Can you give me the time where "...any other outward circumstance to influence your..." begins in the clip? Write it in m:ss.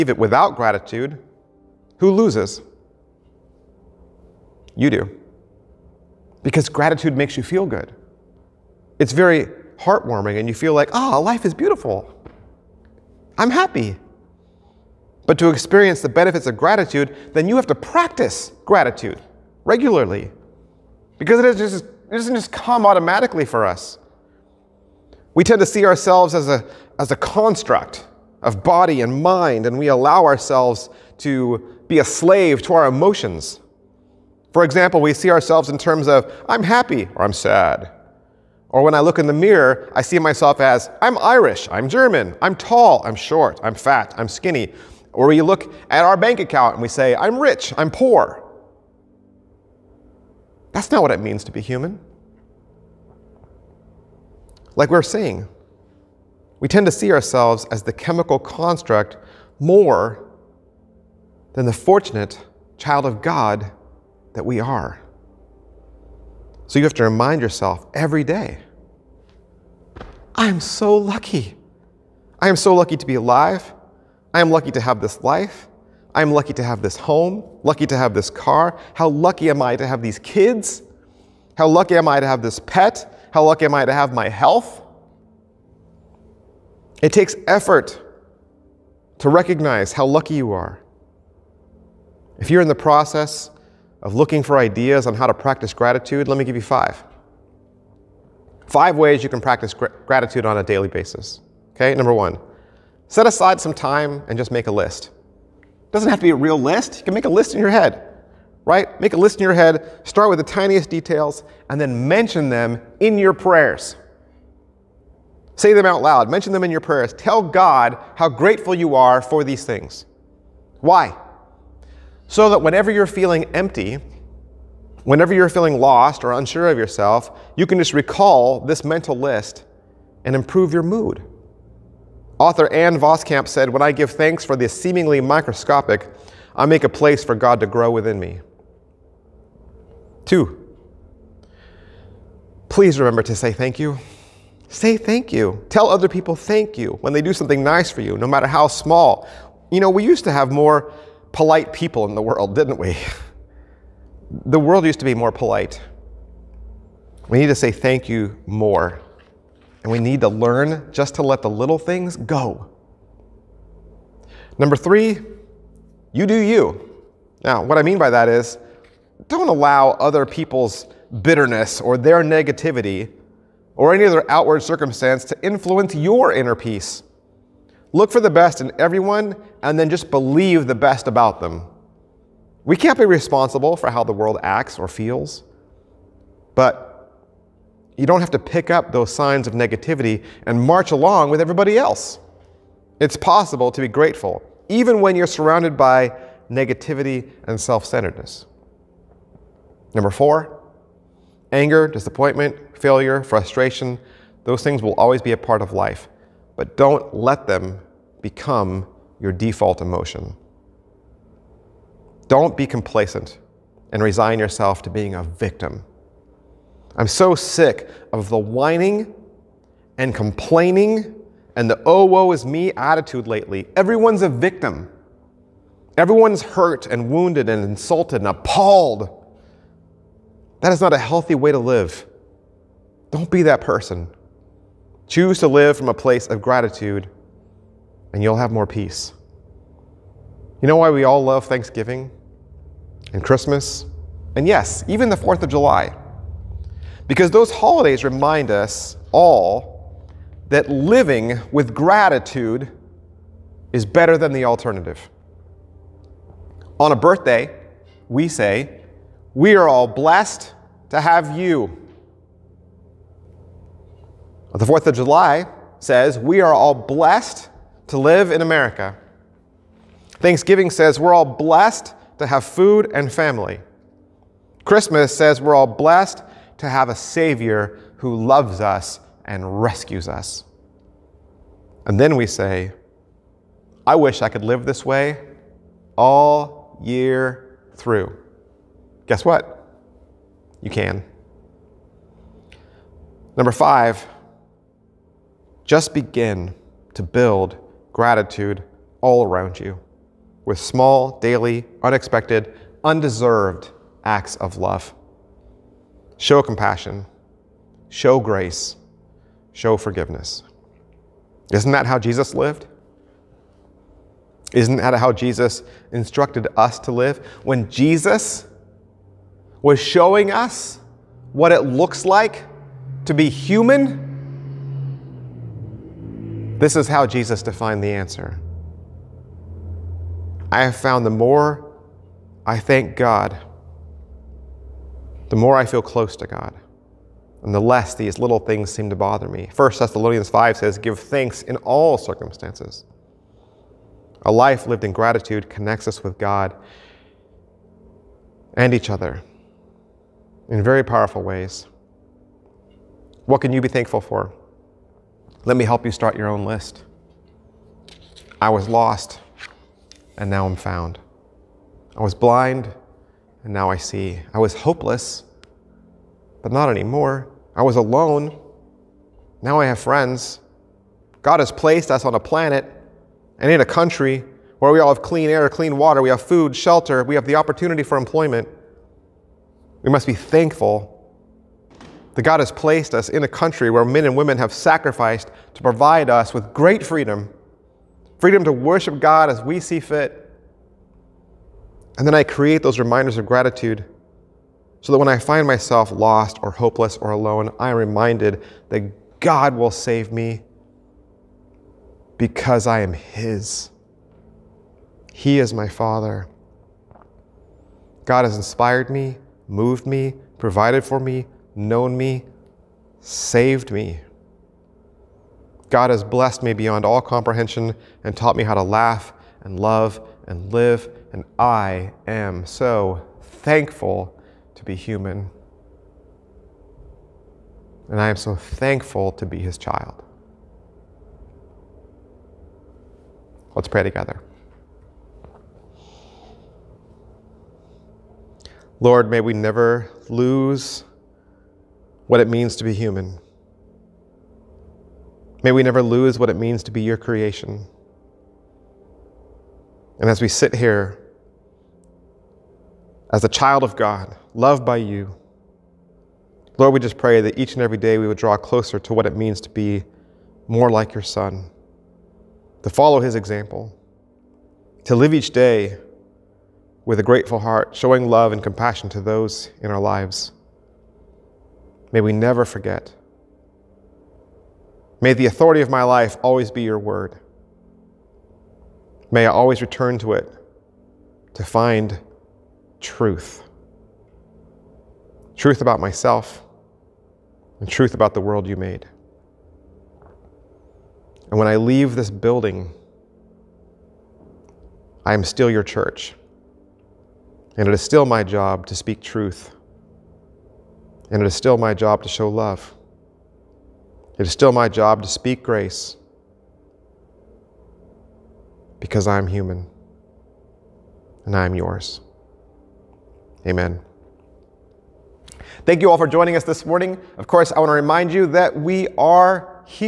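2:53.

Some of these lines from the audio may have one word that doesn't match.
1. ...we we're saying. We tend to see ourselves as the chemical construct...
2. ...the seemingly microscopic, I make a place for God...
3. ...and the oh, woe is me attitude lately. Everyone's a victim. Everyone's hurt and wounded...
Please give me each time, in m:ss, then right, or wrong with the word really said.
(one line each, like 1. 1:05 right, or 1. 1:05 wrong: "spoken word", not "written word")
1. 0:54 right
2. 2:14 right
3. 3:41 right.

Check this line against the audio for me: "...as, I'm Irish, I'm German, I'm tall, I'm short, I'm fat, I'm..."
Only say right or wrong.
right.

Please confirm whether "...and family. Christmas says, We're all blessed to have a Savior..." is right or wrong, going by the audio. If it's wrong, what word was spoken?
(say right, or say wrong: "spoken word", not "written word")
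right.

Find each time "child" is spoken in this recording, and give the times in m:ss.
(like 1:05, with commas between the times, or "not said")
1:02, 7:09, 7:33.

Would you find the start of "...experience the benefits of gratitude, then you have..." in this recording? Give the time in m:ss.
0:15.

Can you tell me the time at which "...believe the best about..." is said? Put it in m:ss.
3:00.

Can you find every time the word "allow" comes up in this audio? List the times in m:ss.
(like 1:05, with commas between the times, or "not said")
0:29, 2:49.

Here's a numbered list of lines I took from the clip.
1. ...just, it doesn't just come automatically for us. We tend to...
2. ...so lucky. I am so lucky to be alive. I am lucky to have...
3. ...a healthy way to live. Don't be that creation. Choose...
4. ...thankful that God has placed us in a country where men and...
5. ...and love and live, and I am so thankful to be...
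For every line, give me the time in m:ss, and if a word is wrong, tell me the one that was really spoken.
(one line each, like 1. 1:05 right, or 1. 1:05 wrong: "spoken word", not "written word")
1. 0:21 right
2. 1:10 right
3. 3:50 wrong: "person", not "creation"
4. 6:20 right
5. 6:59 right.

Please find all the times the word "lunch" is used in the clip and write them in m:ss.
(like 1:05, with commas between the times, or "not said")
not said.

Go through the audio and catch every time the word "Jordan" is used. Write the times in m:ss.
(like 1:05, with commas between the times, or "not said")
not said.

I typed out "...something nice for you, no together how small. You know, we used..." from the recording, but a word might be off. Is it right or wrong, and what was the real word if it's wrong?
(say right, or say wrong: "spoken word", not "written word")
wrong: "matter", not "together".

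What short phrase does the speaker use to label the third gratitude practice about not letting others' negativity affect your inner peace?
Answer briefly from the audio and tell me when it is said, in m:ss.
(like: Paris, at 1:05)
You do you, at 2:46.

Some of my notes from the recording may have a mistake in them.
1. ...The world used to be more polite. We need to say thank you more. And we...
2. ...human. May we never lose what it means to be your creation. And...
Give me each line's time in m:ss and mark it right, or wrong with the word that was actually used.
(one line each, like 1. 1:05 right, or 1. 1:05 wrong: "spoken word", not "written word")
1. 2:34 right
2. 7:22 right.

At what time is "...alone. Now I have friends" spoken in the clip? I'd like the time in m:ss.
6:07.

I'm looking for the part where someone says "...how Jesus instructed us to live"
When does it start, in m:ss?
5:14.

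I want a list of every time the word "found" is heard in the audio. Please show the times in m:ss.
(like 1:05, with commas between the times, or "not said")
5:30, 6:00.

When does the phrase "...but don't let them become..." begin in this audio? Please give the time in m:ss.
3:26.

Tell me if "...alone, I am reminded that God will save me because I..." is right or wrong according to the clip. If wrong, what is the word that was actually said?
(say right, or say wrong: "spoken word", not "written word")
right.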